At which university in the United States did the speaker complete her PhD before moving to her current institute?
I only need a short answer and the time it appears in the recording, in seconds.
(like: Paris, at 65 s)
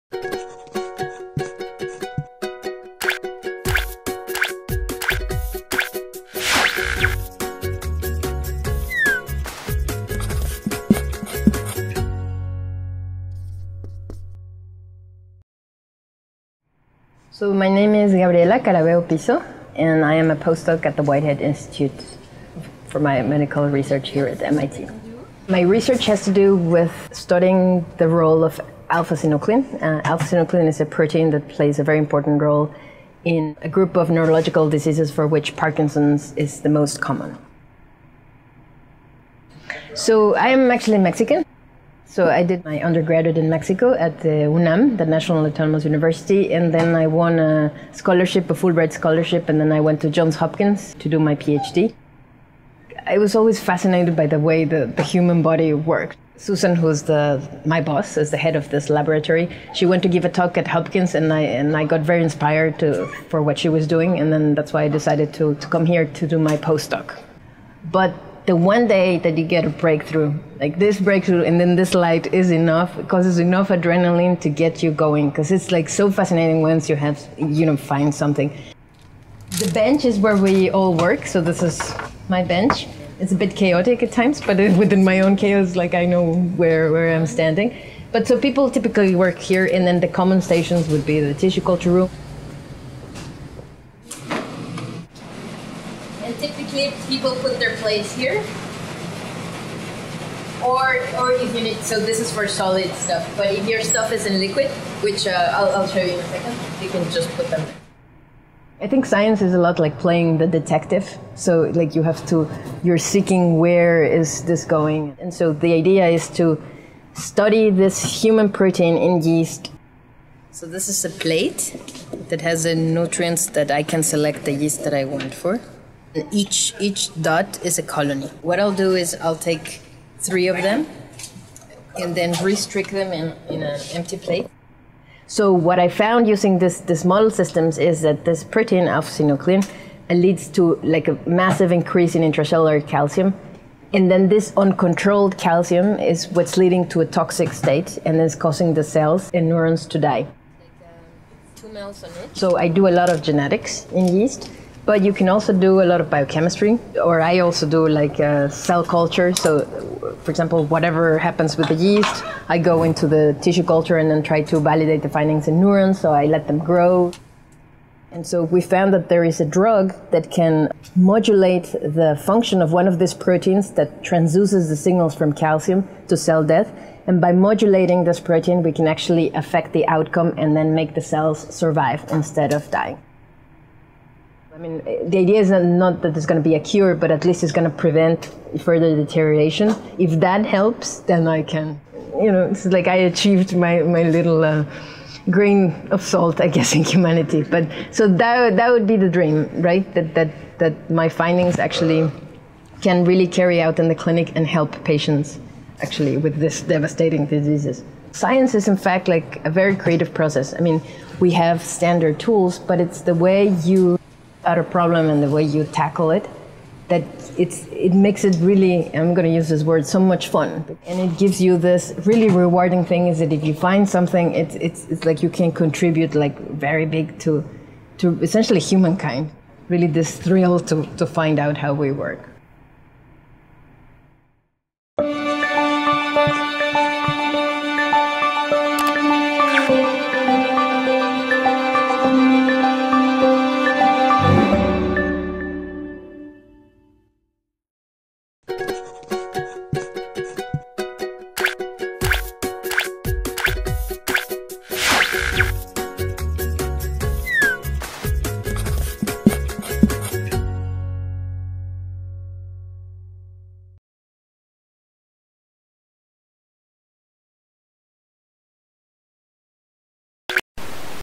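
Johns Hopkins, at 50 s.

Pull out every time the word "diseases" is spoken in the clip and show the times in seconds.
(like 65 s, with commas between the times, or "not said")
34 s, 207 s.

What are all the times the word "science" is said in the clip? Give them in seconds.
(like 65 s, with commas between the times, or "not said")
109 s, 208 s.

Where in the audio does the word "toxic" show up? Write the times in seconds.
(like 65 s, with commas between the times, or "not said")
147 s.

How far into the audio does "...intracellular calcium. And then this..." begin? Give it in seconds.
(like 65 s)
142 s.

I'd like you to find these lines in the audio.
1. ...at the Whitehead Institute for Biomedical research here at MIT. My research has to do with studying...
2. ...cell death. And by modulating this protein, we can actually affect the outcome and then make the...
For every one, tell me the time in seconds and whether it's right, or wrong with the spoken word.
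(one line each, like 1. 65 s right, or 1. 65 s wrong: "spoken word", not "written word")
1. 20 s right
2. 176 s right.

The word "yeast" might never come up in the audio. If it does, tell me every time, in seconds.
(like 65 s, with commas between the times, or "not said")
119 s, 124 s, 154 s, 161 s.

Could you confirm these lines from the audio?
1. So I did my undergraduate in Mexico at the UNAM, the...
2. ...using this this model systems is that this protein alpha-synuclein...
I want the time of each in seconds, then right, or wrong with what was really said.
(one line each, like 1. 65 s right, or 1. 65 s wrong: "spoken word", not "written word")
1. 42 s right
2. 136 s right.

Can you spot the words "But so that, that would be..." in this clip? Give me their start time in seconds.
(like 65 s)
197 s.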